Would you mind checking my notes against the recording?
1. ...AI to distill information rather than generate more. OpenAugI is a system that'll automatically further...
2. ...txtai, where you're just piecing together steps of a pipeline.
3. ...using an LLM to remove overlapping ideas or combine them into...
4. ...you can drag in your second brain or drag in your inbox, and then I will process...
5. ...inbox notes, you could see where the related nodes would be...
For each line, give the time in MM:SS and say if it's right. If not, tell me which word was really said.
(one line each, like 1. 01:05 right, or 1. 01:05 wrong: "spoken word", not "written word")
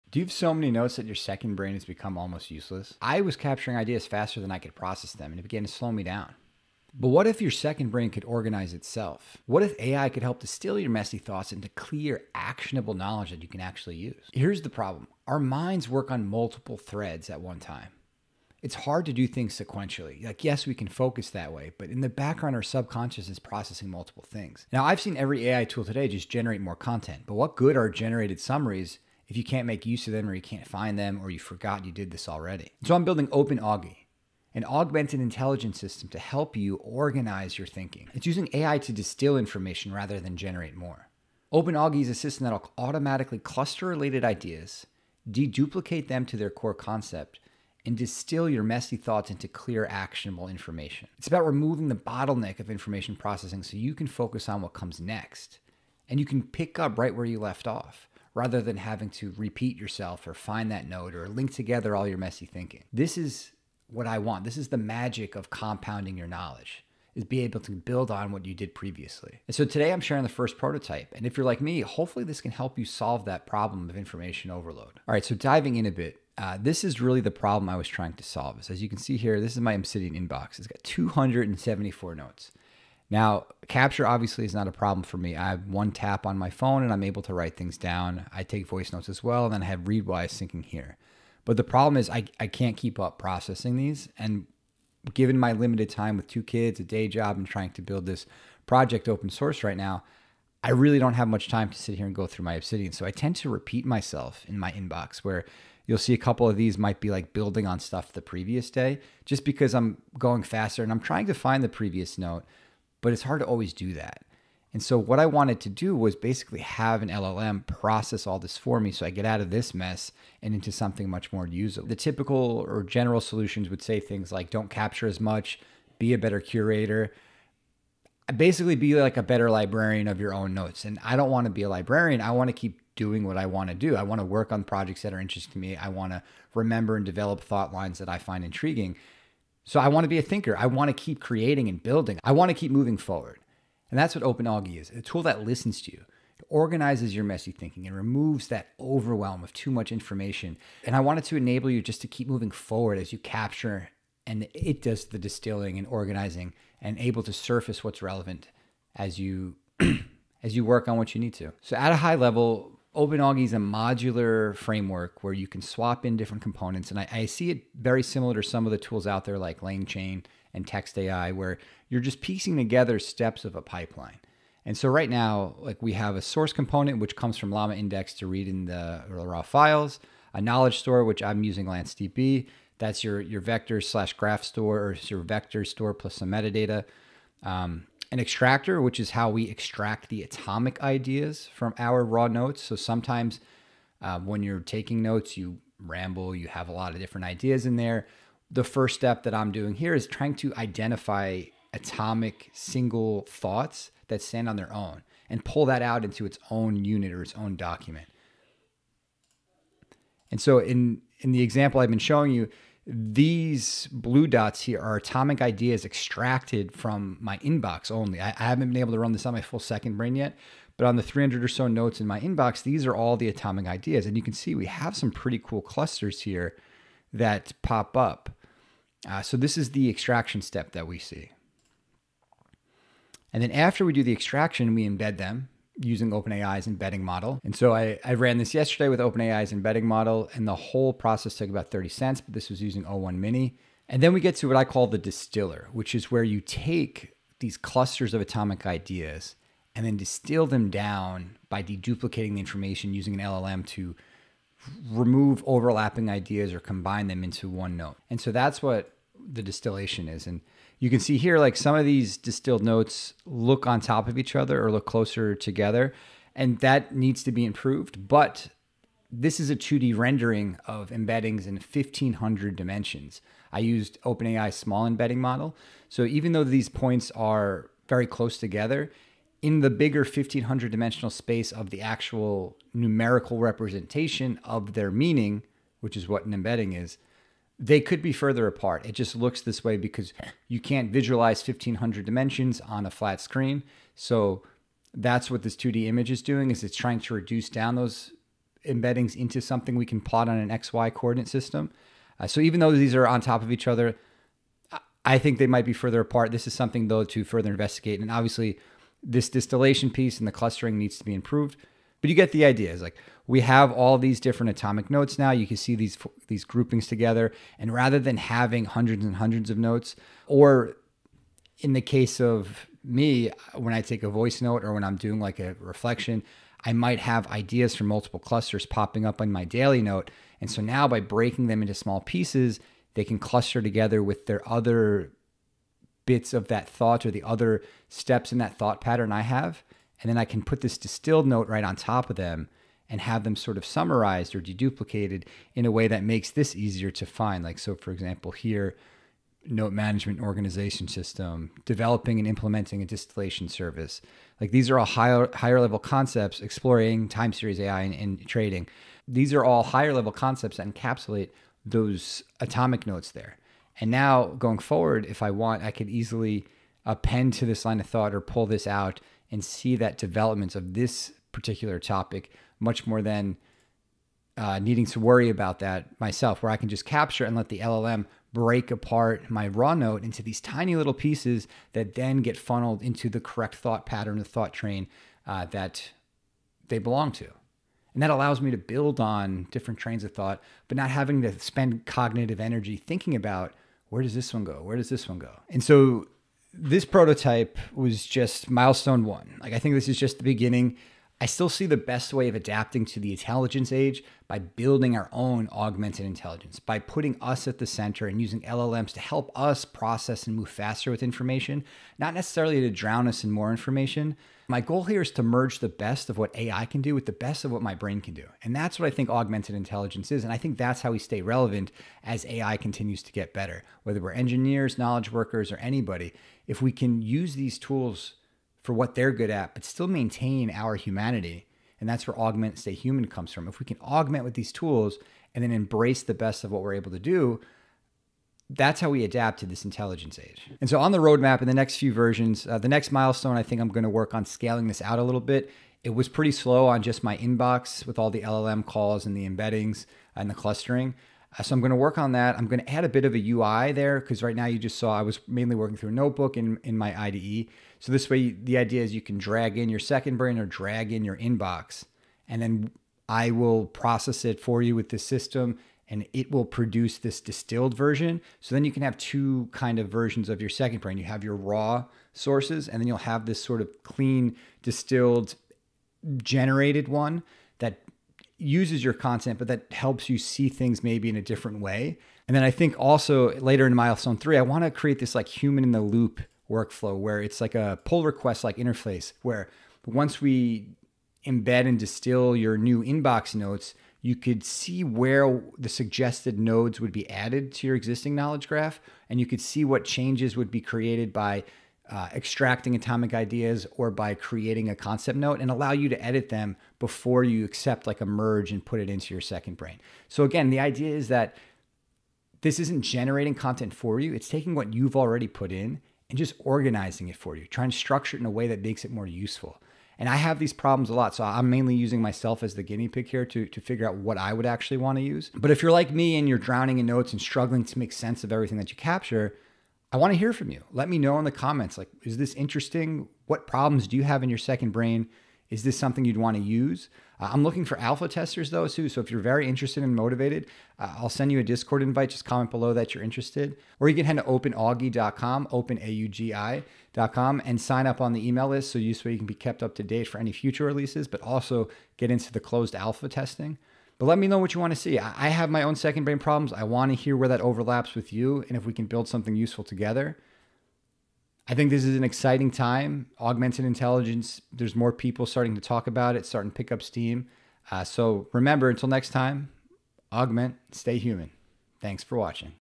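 1. 00:38 wrong: "cluster", not "further"
2. 02:50 right
3. 04:12 right
4. 07:38 right
5. 08:12 wrong: "suggested", not "related".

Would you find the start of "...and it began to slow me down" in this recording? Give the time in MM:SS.
00:05.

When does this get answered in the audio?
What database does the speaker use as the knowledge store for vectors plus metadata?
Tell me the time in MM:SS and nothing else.
03:01.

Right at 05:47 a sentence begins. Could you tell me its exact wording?
Like, so for example, here, note management organization system, developing and implementing a distillation service.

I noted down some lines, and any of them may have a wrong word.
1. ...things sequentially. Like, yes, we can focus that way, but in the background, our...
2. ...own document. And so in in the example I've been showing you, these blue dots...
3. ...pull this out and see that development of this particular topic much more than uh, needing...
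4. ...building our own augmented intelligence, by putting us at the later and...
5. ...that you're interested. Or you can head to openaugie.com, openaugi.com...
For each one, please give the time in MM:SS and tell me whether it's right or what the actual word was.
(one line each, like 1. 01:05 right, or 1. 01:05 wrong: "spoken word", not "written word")
1. 00:19 right
2. 03:27 right
3. 06:08 right
4. 06:44 wrong: "center", not "later"
5. 09:02 right.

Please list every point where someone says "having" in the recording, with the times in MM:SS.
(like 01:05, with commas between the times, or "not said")
00:58, 05:18, 06:30.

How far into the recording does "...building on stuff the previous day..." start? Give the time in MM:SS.
01:47.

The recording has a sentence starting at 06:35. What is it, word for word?
And so this prototype was just milestone one.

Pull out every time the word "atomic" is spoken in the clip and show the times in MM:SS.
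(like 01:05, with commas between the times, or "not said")
03:10, 03:21, 03:34, 03:43, 04:08, 05:14, 06:02, 08:22.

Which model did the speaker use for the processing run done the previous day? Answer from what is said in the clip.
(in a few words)
O1 Mini.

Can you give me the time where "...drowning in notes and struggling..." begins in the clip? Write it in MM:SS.
08:46.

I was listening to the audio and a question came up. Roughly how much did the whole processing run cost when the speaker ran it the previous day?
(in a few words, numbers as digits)
30 cents.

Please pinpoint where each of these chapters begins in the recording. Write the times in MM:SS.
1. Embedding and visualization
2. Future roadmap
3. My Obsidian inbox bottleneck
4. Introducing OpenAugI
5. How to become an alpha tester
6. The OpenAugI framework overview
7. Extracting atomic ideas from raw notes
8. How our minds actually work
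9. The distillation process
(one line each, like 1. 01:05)
1. 03:30
2. 05:30
3. 01:30
4. 01:00
5. 07:00
6. 02:30
7. 03:00
8. 00:30
9. 04:00.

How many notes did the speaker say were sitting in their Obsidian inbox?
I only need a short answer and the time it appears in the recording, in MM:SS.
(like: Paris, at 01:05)
274, at 01:20.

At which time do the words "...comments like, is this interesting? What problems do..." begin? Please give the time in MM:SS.
08:51.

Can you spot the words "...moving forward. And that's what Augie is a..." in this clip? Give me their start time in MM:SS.
02:22.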